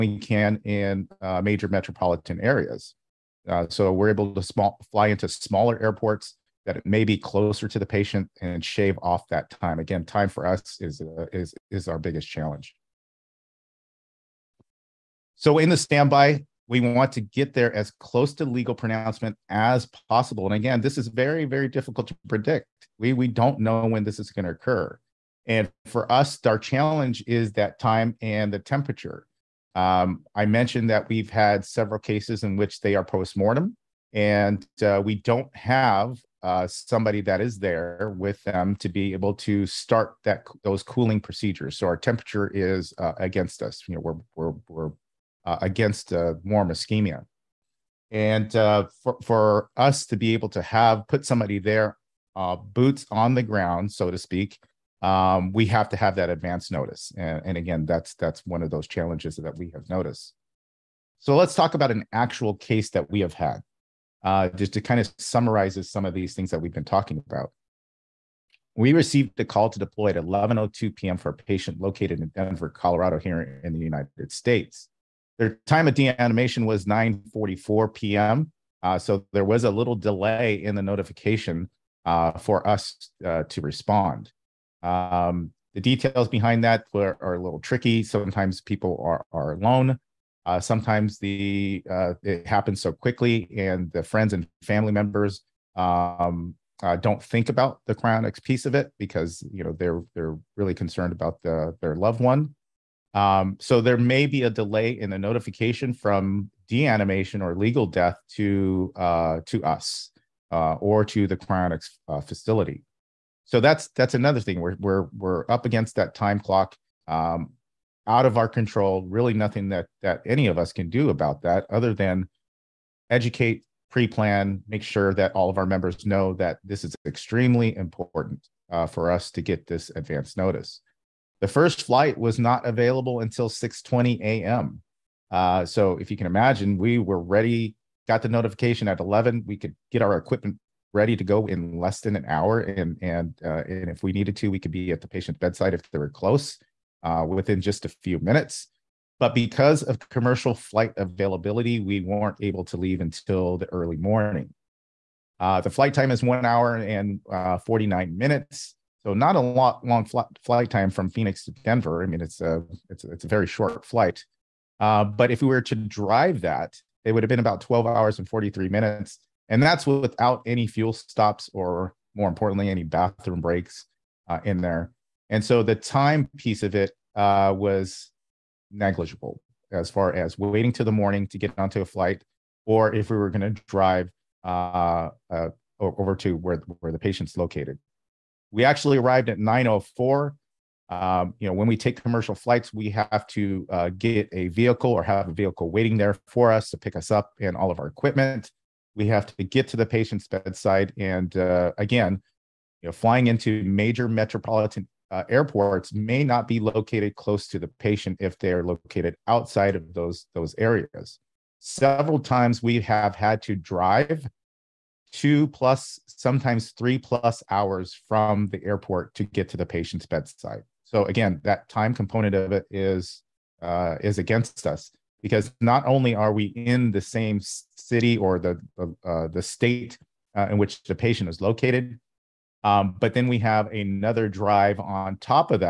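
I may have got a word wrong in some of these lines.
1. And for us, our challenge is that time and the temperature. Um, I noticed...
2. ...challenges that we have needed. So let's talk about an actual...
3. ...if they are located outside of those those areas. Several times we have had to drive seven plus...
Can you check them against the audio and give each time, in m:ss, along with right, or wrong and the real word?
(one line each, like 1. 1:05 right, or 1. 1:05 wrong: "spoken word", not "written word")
1. 0:25 wrong: "mentioned", not "noticed"
2. 0:58 wrong: "noticed", not "needed"
3. 3:28 wrong: "two", not "seven".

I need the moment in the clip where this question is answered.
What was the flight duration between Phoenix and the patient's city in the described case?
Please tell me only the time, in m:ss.
2:36.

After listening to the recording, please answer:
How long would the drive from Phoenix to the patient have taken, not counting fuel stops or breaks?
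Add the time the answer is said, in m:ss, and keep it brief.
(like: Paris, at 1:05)
12 hours and 43 minutes, at 2:47.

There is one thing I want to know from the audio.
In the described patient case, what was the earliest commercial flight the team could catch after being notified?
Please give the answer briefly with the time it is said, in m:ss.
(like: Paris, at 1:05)
6:20 a.m., at 2:13.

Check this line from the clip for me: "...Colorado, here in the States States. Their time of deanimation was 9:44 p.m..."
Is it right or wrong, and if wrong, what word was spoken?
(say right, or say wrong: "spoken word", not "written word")
wrong: "United", not "States".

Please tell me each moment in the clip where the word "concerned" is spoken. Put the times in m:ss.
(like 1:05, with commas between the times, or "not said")
1:40.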